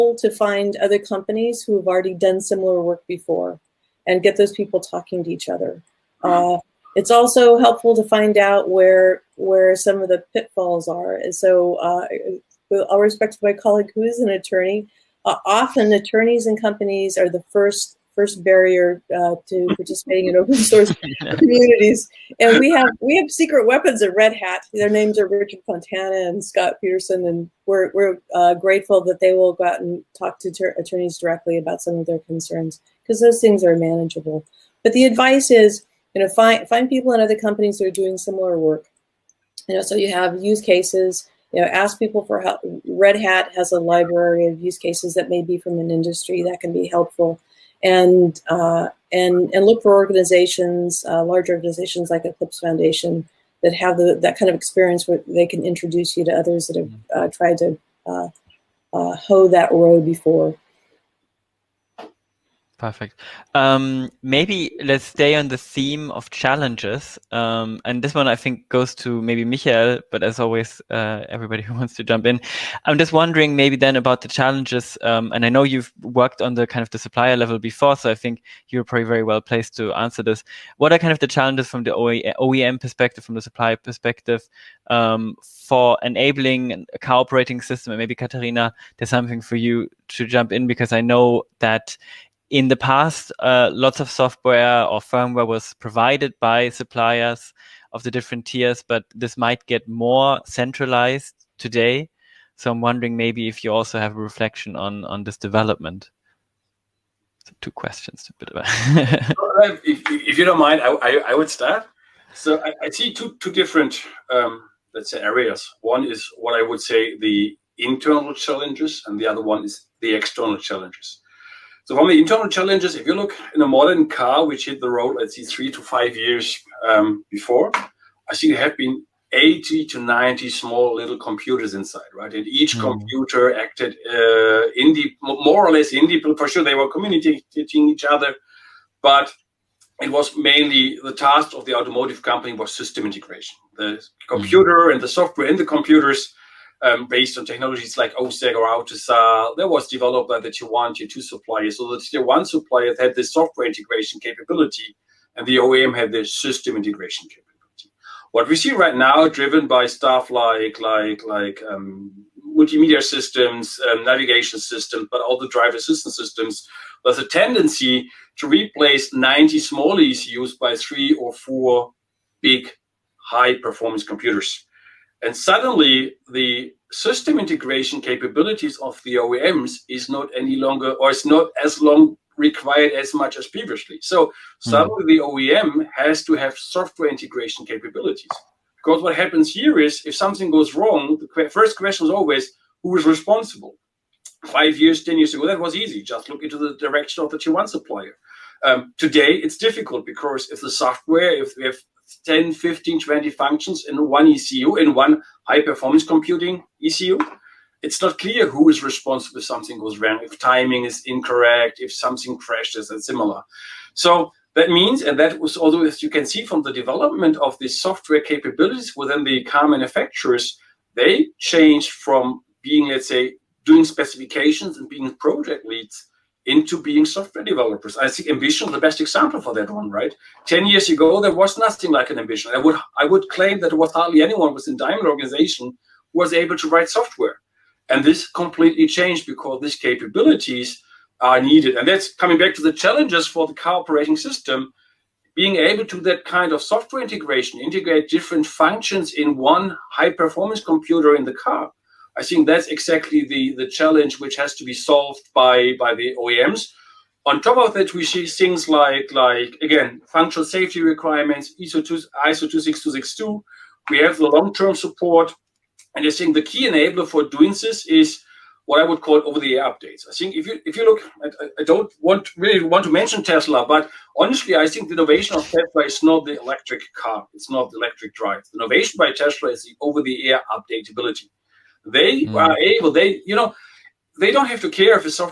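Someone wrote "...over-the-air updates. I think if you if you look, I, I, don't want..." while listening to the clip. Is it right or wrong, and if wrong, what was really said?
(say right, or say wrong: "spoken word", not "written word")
right.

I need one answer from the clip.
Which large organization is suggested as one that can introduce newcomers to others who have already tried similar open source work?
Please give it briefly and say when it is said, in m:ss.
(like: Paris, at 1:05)
Eclipse Foundation, at 0:52.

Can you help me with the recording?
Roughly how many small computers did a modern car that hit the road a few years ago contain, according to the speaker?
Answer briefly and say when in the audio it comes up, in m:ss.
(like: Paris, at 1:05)
80 to 90, at 2:09.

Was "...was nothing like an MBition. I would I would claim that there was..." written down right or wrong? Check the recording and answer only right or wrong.
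right.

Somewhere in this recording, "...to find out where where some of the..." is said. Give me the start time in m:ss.
0:07.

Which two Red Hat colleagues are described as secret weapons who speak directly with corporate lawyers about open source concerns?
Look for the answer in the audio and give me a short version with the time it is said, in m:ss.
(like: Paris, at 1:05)
Richard Fontana and Scott Peterson, at 0:25.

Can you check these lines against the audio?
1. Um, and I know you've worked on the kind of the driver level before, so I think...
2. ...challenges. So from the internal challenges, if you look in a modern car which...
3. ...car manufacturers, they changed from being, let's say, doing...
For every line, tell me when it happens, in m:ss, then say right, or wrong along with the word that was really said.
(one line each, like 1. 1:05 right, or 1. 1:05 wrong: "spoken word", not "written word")
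1. 1:15 wrong: "supplier", not "driver"
2. 2:00 right
3. 3:39 right.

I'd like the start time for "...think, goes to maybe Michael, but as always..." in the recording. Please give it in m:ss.
1:08.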